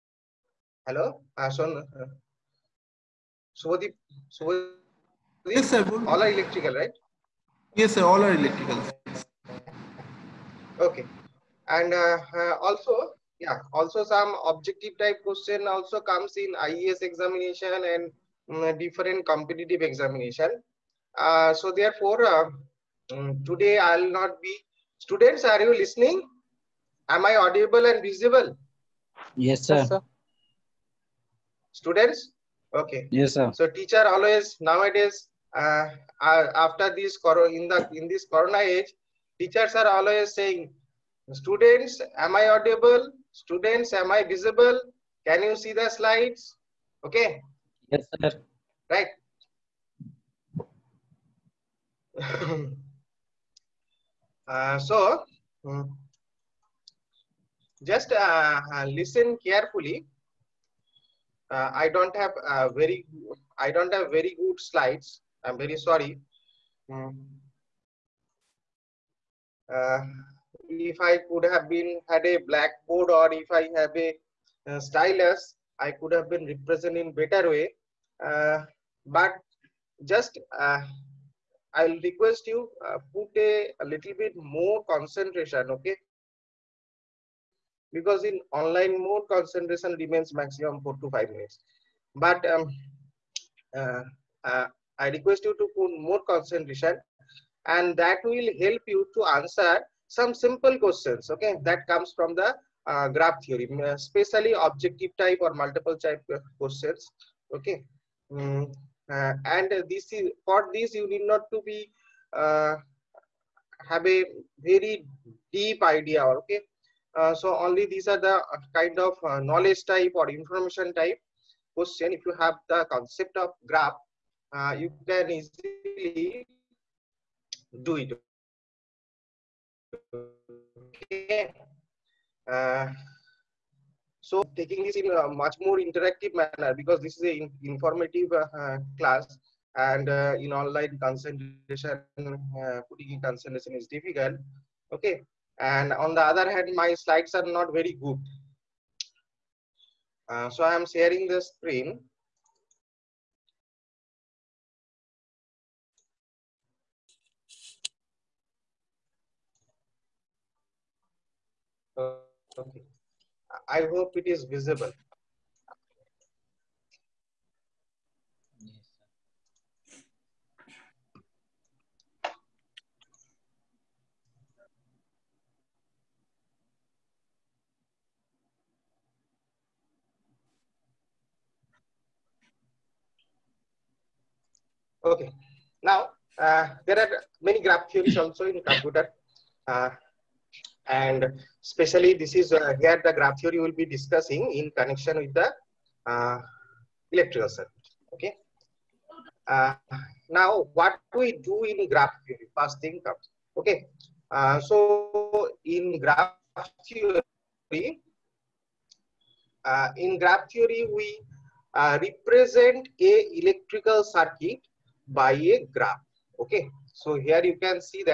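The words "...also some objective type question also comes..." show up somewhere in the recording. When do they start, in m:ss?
0:13.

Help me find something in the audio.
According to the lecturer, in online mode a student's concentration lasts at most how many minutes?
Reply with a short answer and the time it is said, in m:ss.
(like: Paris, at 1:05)
4 to 5 minutes, at 1:30.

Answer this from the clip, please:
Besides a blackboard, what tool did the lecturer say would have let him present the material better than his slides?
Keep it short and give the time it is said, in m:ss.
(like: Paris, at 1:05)
stylus, at 1:14.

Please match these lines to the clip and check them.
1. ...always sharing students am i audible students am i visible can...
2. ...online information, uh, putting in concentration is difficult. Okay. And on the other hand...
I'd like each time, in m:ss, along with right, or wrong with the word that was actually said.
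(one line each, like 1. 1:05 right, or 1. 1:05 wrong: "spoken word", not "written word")
1. 0:39 wrong: "saying", not "sharing"
2. 2:20 wrong: "concentration", not "information".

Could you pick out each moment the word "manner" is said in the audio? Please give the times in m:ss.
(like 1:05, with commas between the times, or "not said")
2:16.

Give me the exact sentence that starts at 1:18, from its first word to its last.
Uh, but just uh, I'll request you uh, put a, a little bit more concentration, okay?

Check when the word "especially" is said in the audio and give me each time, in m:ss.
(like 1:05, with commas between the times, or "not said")
1:43, 3:11.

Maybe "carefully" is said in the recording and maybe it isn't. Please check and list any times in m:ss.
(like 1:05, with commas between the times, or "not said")
0:59.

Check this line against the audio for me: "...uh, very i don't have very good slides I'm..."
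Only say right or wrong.
right.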